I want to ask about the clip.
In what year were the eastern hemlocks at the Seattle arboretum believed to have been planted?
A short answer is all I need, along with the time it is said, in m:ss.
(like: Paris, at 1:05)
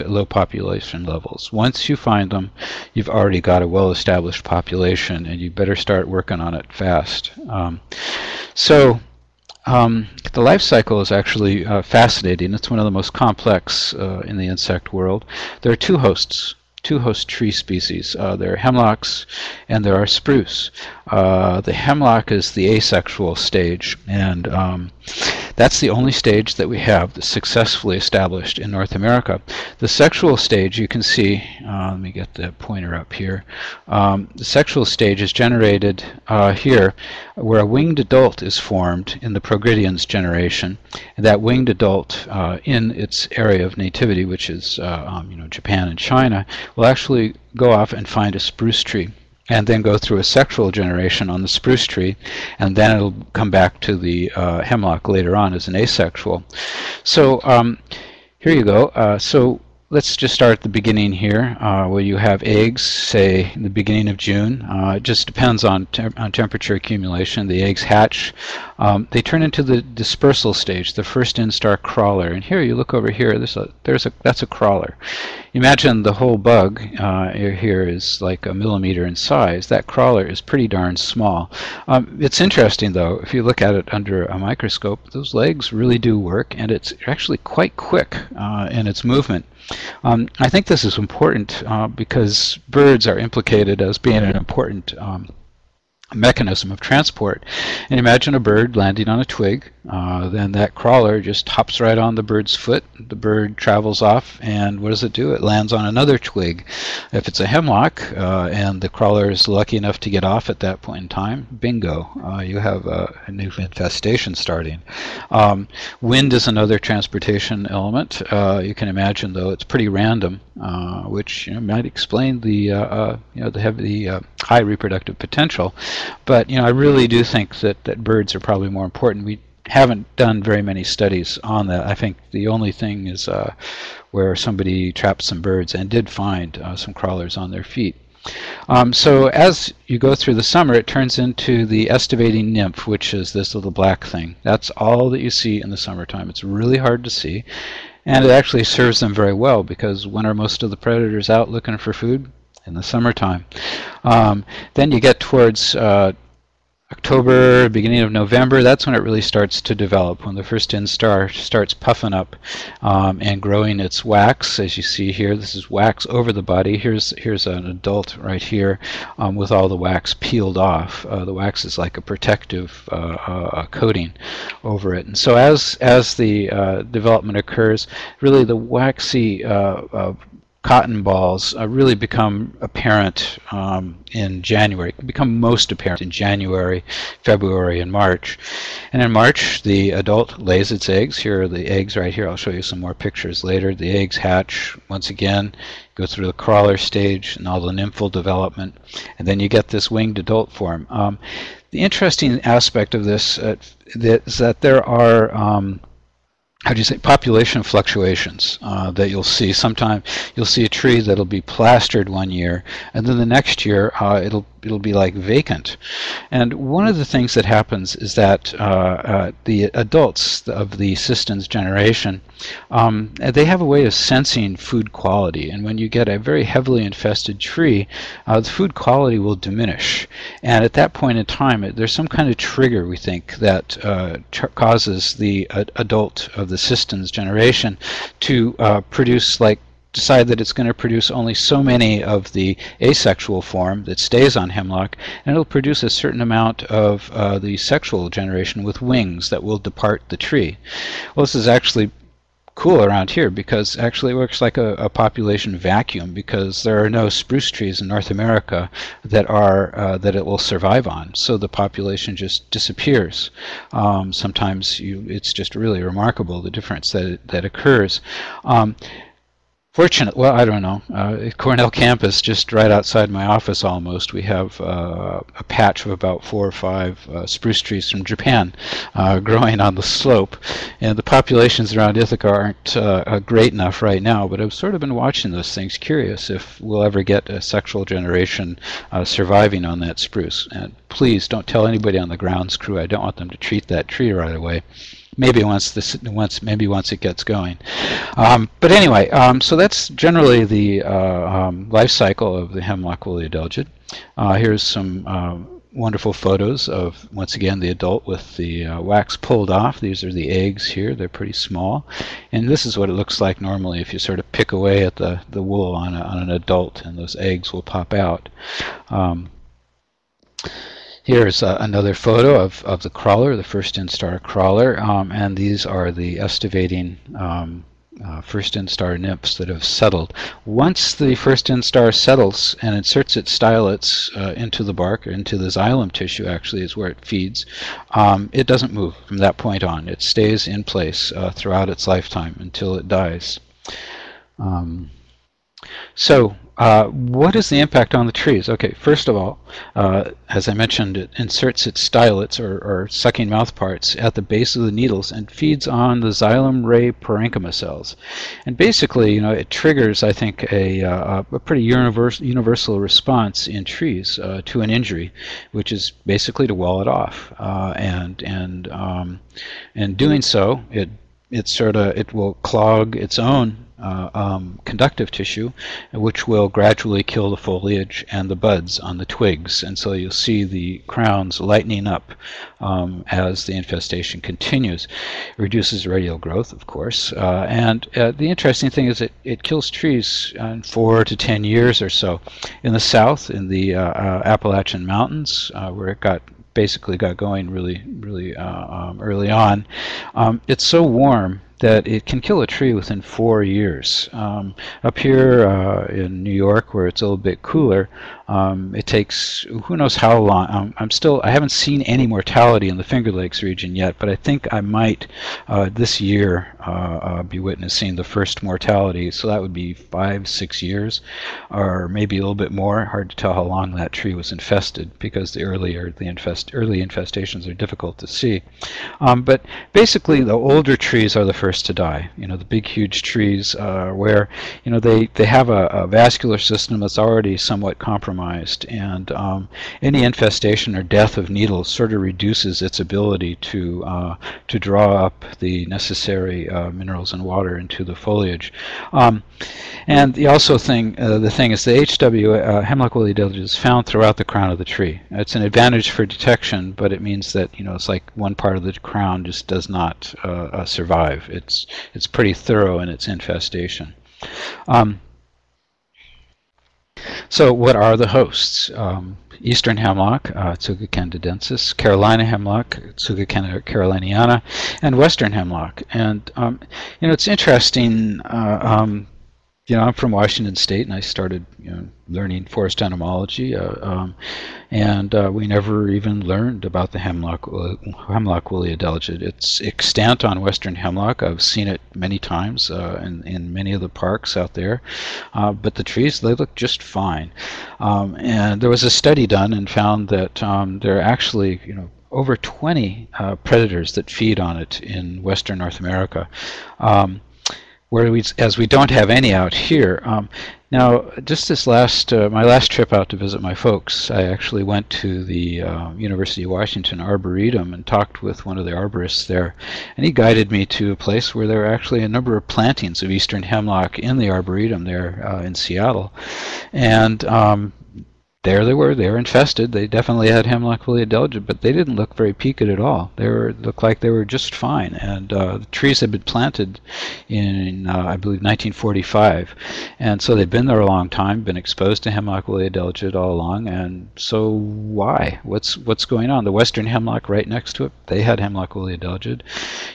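1945, at 8:58.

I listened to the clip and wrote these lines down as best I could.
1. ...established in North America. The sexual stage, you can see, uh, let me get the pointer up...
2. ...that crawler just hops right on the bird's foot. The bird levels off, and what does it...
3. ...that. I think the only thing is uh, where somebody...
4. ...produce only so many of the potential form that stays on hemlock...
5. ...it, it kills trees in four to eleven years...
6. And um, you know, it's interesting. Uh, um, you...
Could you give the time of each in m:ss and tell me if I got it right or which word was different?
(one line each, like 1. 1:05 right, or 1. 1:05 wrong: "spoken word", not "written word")
1. 0:27 right
2. 1:40 wrong: "travels", not "levels"
3. 2:11 right
4. 4:00 wrong: "asexual", not "potential"
5. 6:29 wrong: "ten", not "eleven"
6. 7:55 right.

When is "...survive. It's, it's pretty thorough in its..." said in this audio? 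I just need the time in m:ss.
7:40.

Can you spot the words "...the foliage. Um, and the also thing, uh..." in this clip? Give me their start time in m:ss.
7:27.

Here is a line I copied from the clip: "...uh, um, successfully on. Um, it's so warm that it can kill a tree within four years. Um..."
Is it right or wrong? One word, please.
wrong.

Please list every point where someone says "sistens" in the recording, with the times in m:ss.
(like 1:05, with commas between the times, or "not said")
3:40, 3:56.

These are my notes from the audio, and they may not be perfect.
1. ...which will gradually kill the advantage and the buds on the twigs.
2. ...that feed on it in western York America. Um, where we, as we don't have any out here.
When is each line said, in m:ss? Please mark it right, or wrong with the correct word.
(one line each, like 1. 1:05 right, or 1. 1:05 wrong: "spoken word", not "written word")
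1. 6:15 wrong: "foliage", not "advantage"
2. 8:23 wrong: "North", not "York".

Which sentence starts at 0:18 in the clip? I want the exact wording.
Uh, there are hemlocks and there are spruce.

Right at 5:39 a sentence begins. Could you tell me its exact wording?
It stays in place uh, throughout its lifetime until it dies.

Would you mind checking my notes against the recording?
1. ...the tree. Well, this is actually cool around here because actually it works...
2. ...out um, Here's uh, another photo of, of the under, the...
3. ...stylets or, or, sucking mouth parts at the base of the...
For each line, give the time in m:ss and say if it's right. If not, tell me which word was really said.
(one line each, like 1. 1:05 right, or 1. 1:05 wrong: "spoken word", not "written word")
1. 4:10 right
2. 5:17 wrong: "crawler", not "under"
3. 5:51 right.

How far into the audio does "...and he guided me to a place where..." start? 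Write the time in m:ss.
8:39.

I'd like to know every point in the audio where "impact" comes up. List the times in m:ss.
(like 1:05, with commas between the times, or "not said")
5:47.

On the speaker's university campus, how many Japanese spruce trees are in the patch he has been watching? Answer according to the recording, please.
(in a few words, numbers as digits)
4 or 5.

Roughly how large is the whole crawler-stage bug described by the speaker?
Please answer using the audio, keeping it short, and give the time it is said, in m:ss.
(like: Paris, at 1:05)
1 millimeter, at 1:18.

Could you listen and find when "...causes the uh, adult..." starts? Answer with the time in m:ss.
3:54.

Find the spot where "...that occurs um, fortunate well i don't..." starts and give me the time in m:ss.
4:27.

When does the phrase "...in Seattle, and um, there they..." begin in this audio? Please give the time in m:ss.
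8:45.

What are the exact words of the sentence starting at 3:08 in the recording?
And in March, the adult lays its eggs.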